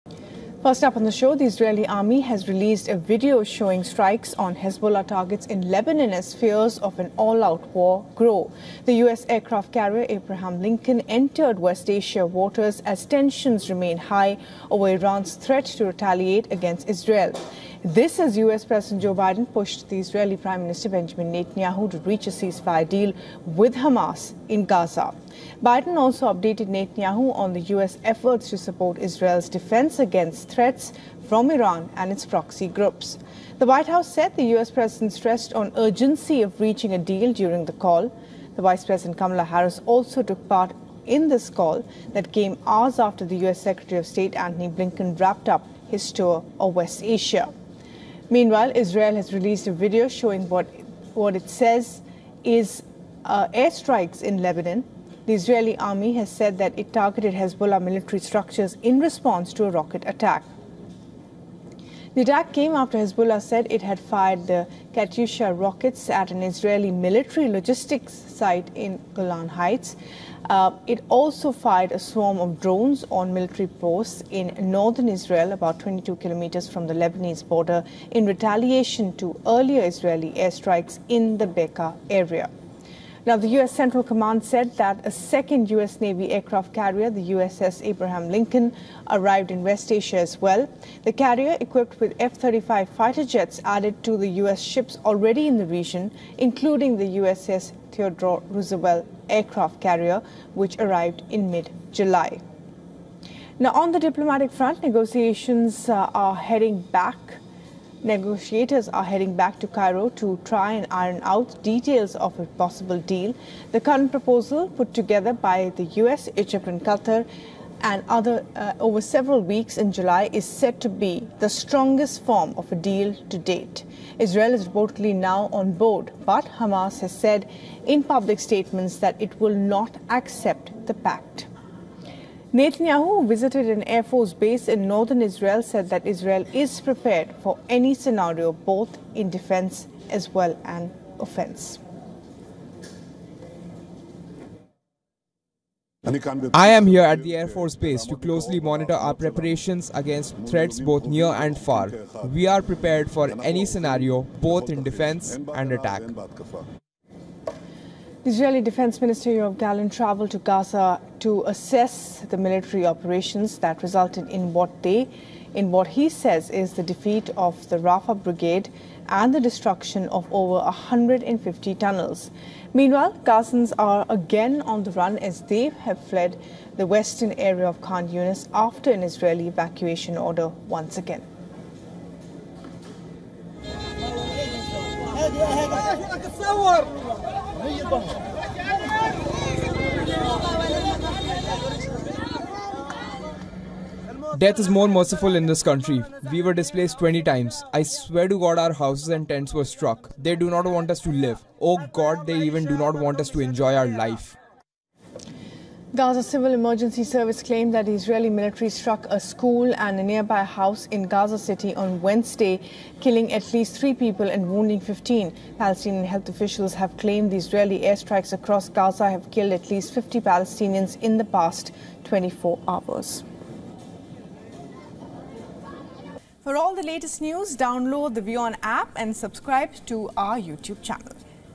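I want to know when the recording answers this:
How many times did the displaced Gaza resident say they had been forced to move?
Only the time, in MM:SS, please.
03:16.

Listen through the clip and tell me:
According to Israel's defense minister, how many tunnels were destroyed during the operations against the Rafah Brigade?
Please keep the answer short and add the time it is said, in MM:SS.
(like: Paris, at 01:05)
over 150, at 02:50.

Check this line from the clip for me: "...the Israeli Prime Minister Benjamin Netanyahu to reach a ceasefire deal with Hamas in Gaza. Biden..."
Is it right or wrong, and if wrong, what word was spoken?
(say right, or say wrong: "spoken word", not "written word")
right.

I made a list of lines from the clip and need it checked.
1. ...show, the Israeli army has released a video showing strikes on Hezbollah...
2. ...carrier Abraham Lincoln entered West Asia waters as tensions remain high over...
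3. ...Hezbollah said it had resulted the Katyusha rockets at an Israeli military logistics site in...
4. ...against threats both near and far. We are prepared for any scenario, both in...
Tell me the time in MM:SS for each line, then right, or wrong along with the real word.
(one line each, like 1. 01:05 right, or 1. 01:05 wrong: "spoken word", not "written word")
1. 00:01 right
2. 00:09 right
3. 01:02 wrong: "fired", not "resulted"
4. 02:29 right.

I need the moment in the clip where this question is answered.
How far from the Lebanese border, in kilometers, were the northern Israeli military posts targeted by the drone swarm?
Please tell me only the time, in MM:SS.
01:15.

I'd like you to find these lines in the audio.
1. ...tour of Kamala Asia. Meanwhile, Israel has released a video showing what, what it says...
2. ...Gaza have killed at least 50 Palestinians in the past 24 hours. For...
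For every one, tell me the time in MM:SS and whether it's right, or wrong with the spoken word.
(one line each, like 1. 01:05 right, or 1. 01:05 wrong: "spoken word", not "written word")
1. 00:46 wrong: "West", not "Kamala"
2. 03:38 right.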